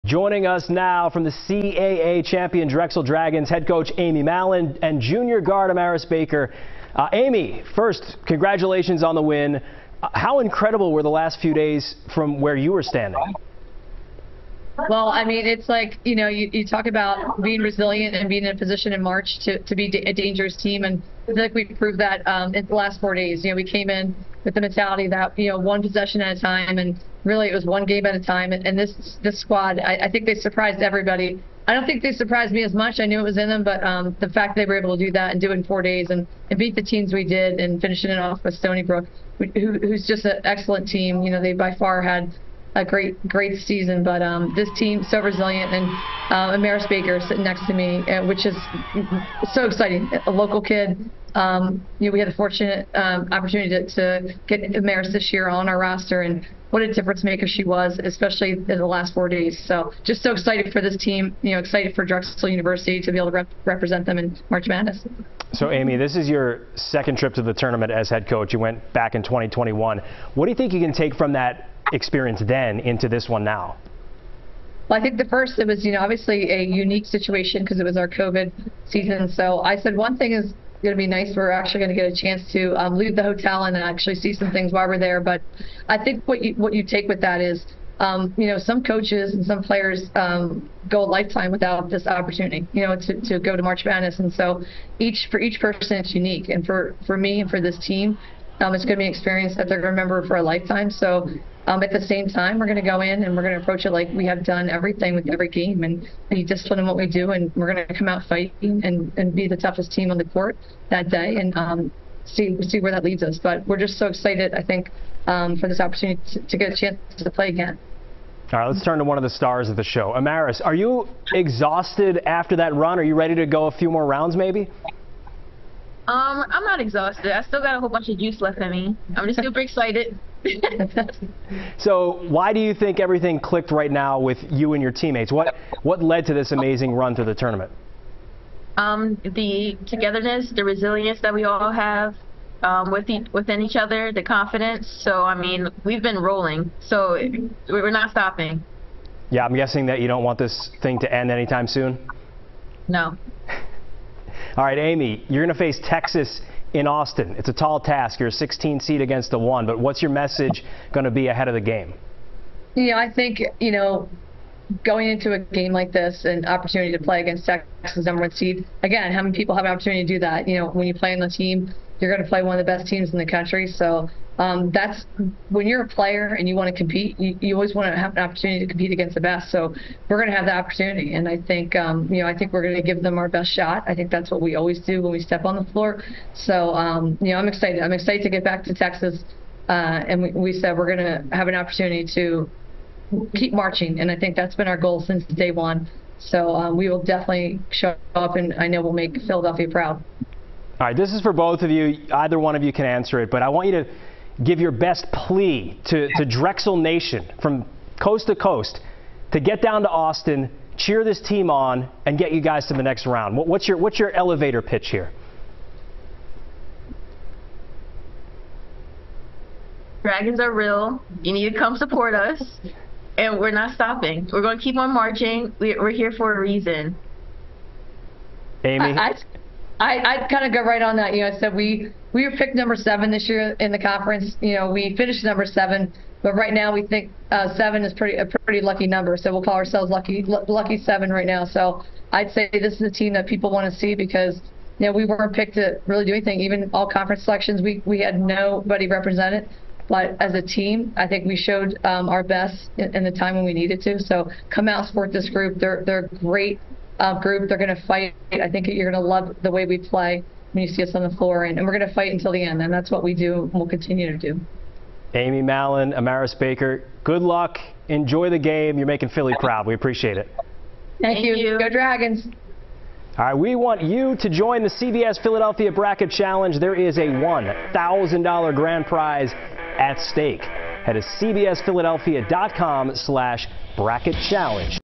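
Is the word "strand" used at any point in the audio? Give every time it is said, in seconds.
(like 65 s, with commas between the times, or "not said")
not said.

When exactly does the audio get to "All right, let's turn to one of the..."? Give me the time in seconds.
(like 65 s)
118 s.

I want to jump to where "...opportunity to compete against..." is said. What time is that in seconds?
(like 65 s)
178 s.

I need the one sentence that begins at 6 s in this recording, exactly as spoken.
Uh, Amy, first, congratulations on the win.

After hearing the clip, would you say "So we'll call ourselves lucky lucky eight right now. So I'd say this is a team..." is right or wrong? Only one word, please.
wrong.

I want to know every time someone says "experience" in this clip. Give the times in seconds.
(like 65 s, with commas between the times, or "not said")
71 s, 99 s.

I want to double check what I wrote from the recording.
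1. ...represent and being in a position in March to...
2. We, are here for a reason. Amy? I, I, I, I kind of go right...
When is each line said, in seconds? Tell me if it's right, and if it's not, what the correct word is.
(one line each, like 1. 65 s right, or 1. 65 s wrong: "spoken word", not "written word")
1. 17 s wrong: "resilient", not "represent"
2. 225 s right.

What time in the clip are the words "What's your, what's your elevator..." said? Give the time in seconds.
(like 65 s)
213 s.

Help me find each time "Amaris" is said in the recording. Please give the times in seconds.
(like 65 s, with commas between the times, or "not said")
5 s, 46 s, 54 s, 120 s, 265 s.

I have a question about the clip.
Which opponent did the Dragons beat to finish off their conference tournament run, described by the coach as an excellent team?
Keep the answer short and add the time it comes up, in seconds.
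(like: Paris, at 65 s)
Stony Brook, at 38 s.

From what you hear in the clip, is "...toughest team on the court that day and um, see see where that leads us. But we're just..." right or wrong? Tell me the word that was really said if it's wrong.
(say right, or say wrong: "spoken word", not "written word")
right.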